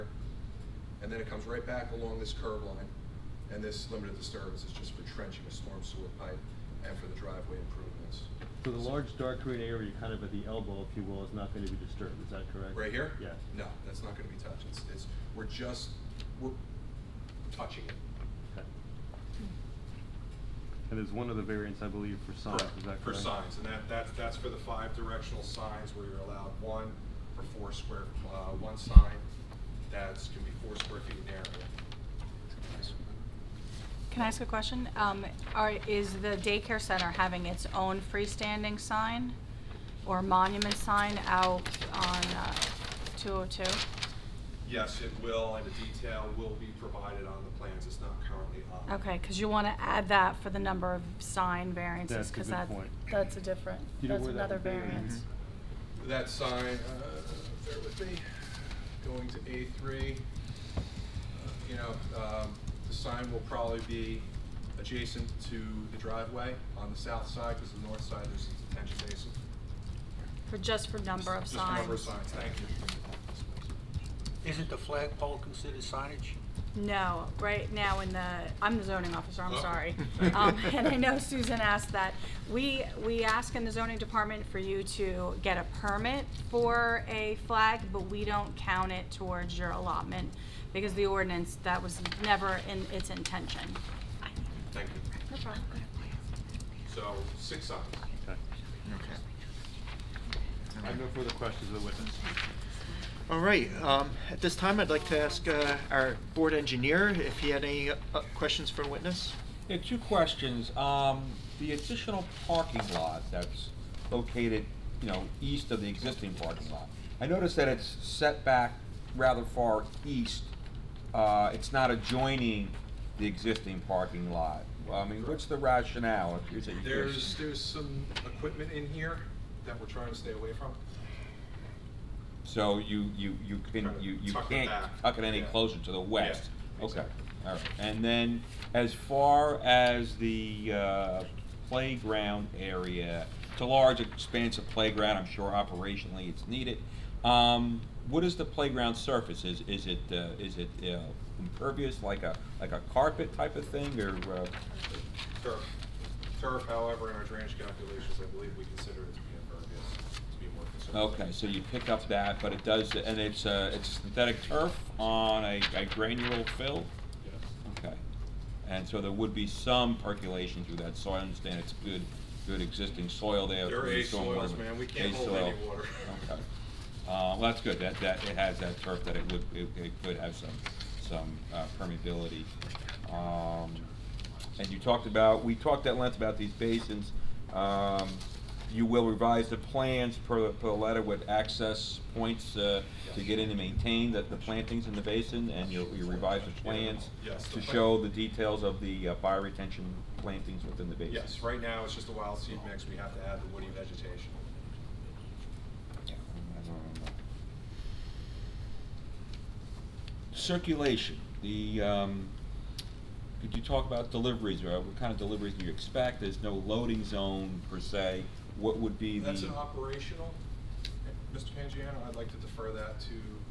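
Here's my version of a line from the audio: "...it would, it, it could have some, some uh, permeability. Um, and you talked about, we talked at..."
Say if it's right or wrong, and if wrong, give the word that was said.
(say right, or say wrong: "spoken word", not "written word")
right.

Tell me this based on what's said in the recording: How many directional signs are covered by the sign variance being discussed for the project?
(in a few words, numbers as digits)
5.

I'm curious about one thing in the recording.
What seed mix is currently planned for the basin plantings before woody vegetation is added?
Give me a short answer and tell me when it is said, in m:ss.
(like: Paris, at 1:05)
Wild seed mix, at 3:22.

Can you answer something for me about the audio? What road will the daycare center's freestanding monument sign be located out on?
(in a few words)
202.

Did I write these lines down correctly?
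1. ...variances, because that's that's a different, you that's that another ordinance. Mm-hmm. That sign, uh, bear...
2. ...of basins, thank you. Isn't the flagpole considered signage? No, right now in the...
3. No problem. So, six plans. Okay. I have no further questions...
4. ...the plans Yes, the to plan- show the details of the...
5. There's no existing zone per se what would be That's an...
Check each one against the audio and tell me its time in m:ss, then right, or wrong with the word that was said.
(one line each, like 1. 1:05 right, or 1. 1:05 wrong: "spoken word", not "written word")
1. 0:51 wrong: "variance", not "ordinance"
2. 1:11 wrong: "signs", not "basins"
3. 1:35 wrong: "signs", not "plans"
4. 3:16 right
5. 3:36 wrong: "loading", not "existing".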